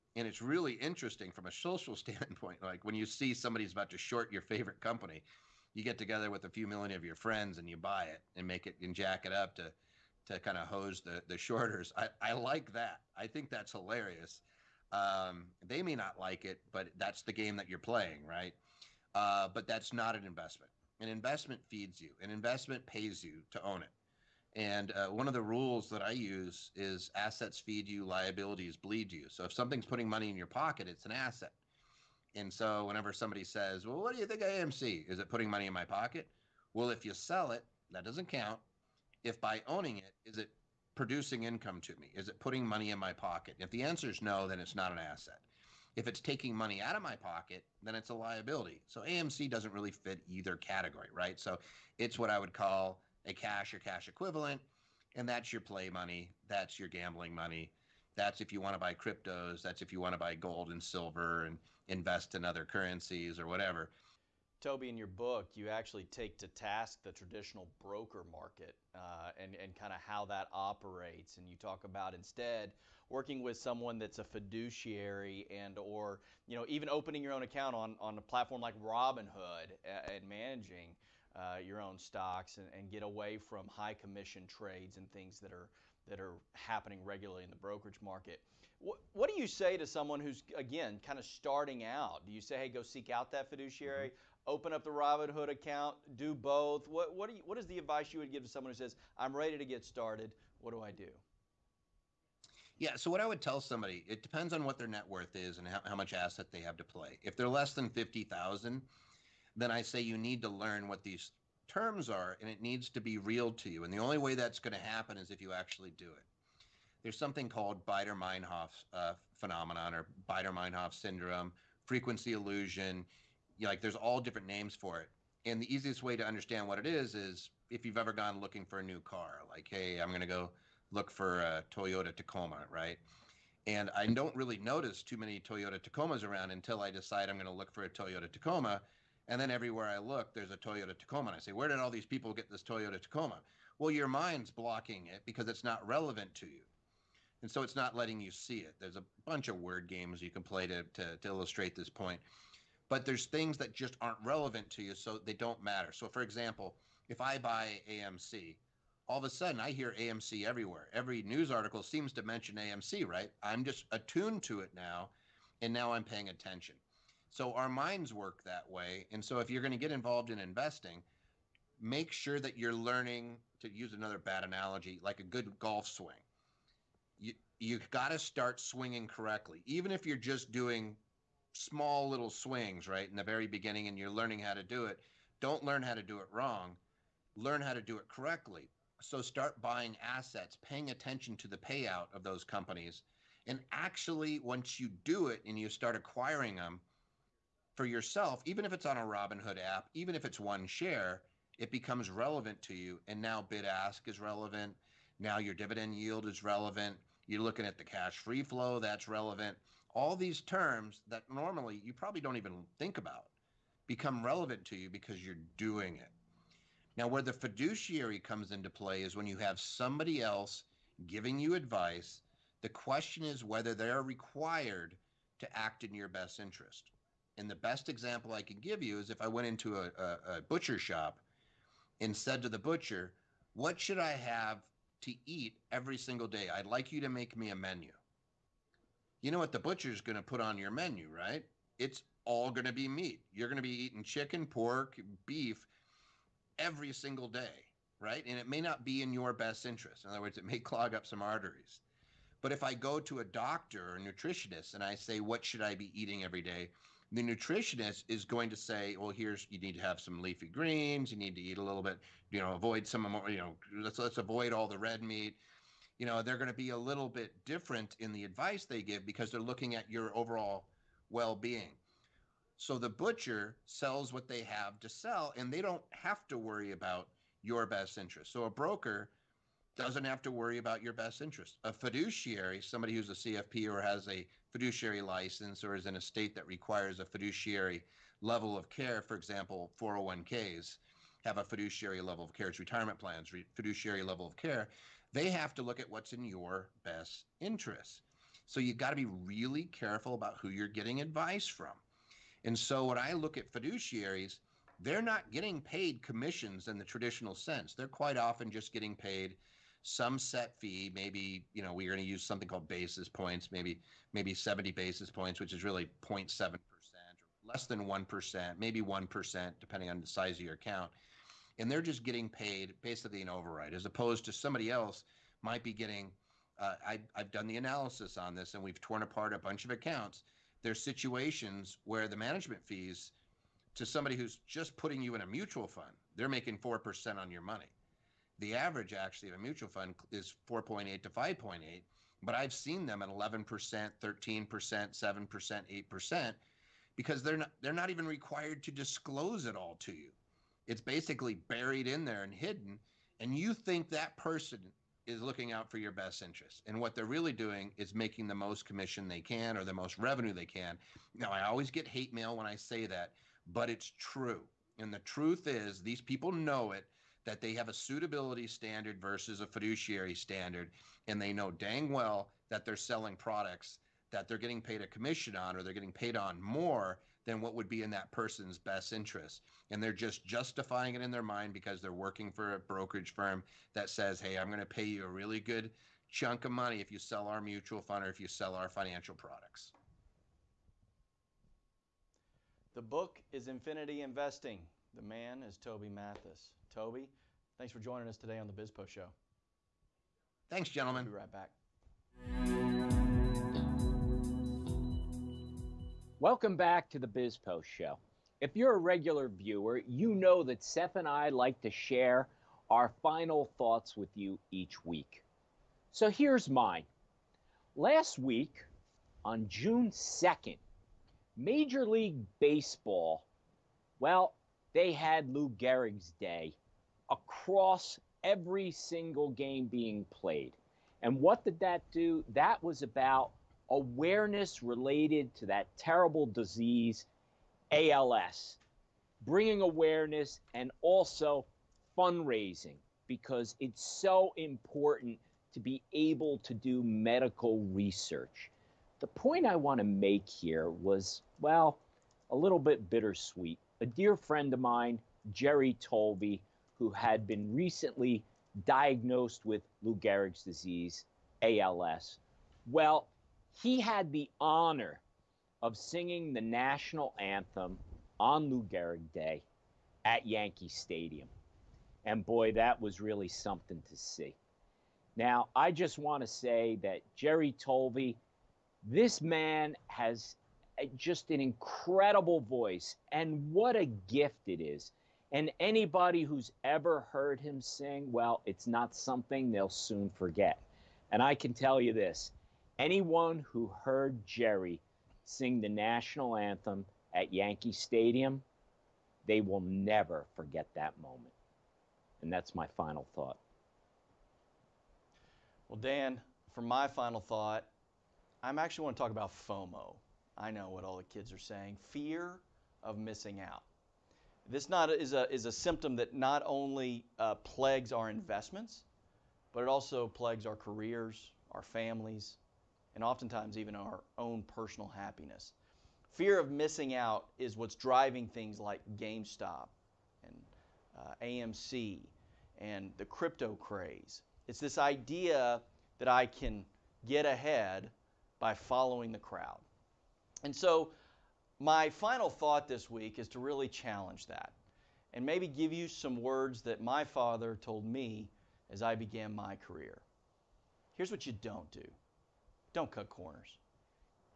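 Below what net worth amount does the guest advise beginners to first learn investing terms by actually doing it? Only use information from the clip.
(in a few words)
50,000.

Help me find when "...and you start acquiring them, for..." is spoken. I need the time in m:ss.
3:15.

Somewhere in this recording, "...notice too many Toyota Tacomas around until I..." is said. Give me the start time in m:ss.
2:14.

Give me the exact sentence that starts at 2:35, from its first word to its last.
So, for example, if I buy AMC, all of a sudden I hear AMC everywhere.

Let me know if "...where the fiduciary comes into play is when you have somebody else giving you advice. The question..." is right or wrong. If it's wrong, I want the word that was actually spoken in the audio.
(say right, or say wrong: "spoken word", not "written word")
right.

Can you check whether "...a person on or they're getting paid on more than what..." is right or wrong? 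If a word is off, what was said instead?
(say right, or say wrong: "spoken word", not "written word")
wrong: "commission", not "person".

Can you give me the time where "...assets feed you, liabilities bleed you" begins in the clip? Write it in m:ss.
0:27.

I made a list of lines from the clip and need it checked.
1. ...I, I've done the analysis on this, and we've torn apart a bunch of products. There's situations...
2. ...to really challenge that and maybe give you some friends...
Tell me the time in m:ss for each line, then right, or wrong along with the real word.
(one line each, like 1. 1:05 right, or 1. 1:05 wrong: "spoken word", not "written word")
1. 5:26 wrong: "accounts", not "products"
2. 9:03 wrong: "words", not "friends".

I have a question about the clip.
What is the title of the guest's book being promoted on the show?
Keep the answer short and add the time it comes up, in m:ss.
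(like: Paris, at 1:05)
Infinity Investing, at 6:33.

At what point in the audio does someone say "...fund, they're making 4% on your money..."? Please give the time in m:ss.
5:35.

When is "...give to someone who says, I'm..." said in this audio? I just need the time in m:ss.
1:38.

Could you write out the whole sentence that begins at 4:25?
You know, they're going to be a little bit different in the advice they give because they're looking at your overall well-being.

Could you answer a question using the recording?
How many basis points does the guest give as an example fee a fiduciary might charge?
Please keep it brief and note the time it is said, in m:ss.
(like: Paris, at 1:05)
70, at 5:14.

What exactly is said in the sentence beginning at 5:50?
It's basically buried in there and hidden and you think that person is looking out for your best interest.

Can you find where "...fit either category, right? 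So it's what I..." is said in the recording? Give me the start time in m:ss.
0:49.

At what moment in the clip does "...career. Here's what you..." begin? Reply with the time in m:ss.
9:09.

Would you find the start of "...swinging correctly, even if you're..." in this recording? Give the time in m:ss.
2:58.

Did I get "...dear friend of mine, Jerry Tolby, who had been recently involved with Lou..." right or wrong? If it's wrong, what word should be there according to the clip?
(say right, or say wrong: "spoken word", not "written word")
wrong: "diagnosed", not "involved".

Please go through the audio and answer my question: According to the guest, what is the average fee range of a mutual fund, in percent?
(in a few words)
4.8 to 5.8%.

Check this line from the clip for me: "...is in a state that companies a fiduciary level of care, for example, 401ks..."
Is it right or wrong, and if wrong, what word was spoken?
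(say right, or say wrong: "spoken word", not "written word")
wrong: "requires", not "companies".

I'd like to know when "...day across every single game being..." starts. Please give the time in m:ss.
7:06.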